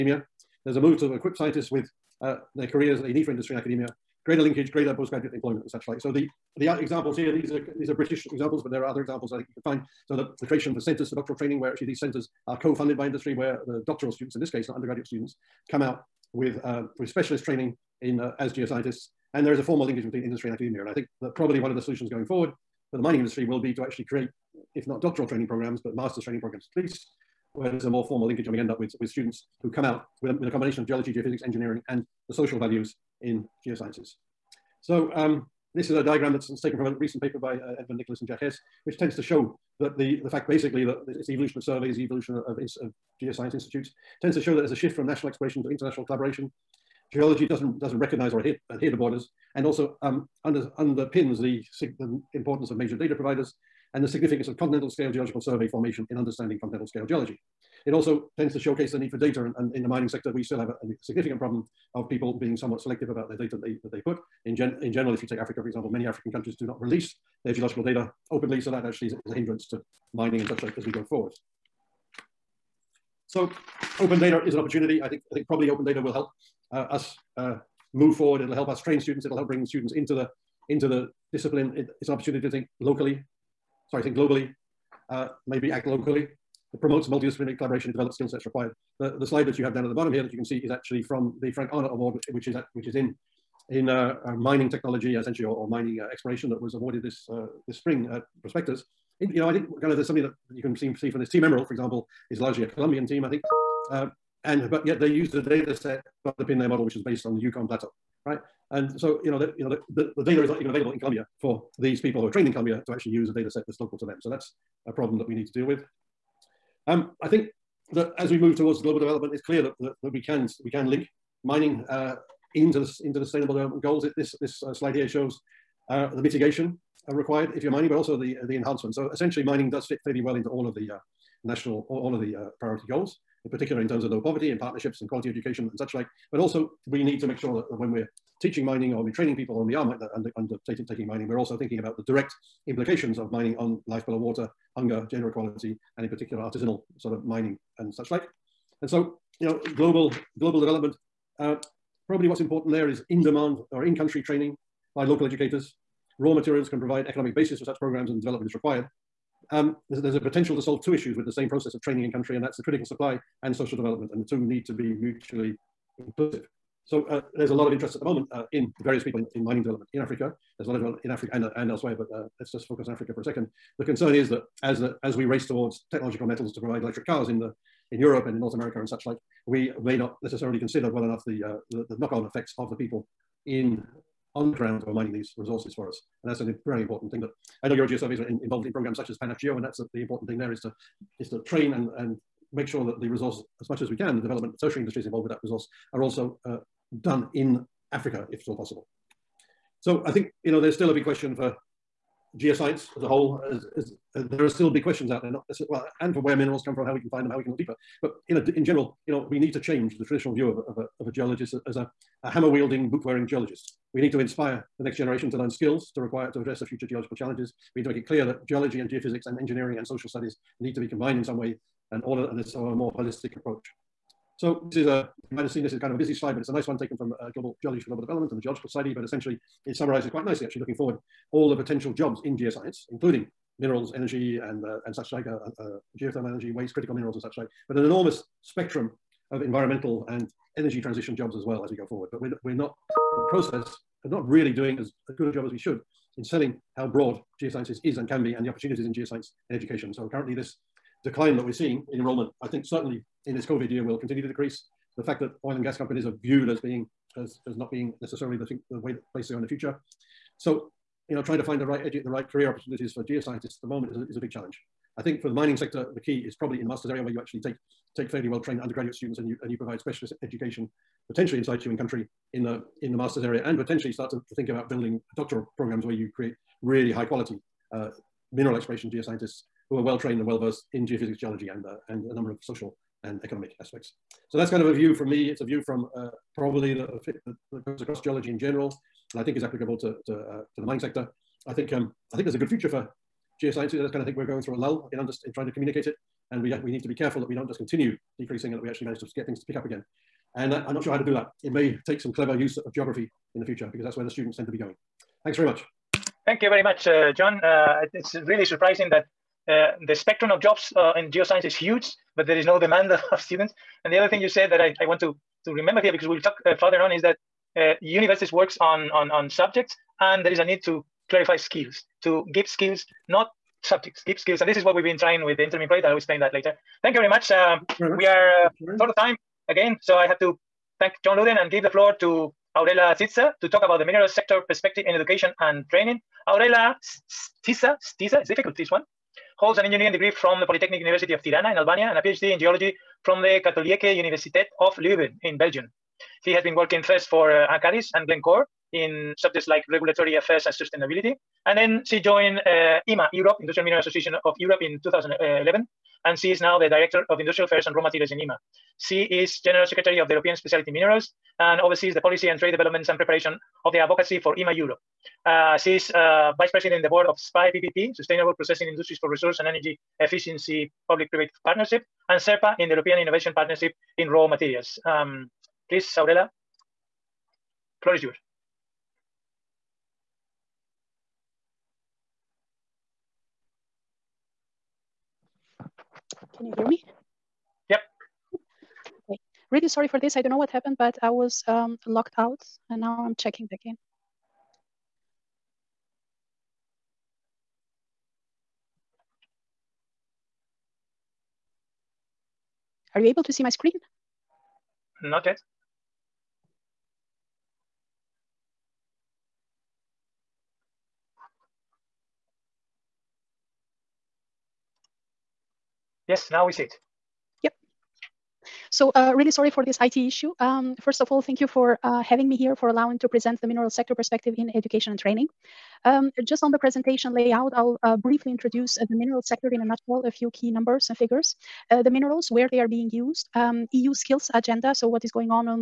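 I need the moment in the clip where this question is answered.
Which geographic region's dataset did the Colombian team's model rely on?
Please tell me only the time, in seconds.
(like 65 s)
107 s.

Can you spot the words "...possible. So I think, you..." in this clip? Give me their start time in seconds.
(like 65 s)
198 s.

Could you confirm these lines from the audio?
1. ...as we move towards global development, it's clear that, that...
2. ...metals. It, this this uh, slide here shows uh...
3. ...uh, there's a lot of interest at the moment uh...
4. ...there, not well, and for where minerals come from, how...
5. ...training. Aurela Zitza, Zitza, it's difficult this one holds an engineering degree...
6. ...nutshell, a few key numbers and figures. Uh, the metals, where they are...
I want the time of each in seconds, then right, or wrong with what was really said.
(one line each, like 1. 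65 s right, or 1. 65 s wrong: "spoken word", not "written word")
1. 118 s right
2. 123 s wrong: "goals", not "metals"
3. 167 s right
4. 205 s right
5. 335 s right
6. 429 s wrong: "minerals", not "metals".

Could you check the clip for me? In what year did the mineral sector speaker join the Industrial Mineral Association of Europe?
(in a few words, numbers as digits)
2011.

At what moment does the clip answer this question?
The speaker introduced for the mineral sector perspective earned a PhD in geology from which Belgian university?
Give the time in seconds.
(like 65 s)
343 s.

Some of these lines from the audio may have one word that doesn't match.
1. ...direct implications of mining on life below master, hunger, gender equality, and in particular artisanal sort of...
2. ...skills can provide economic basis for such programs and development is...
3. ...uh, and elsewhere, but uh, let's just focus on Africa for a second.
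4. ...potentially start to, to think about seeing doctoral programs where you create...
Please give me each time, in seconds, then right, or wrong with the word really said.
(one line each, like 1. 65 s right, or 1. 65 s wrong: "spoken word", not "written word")
1. 142 s wrong: "water", not "master"
2. 156 s wrong: "materials", not "skills"
3. 171 s right
4. 273 s wrong: "building", not "seeing".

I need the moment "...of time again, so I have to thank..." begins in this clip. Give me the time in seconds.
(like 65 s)
328 s.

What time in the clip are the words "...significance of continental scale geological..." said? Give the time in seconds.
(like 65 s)
54 s.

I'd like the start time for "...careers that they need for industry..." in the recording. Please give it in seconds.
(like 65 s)
2 s.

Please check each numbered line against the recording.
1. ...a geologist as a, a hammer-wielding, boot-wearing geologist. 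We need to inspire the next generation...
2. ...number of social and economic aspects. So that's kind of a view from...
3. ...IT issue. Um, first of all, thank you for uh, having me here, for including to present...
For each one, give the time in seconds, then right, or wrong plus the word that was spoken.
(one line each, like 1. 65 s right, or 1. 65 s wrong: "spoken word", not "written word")
1. 211 s right
2. 282 s right
3. 419 s wrong: "allowing", not "including".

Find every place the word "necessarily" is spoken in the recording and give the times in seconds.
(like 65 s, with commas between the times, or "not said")
180 s, 258 s.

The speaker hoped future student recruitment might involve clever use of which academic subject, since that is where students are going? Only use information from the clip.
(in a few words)
Geography.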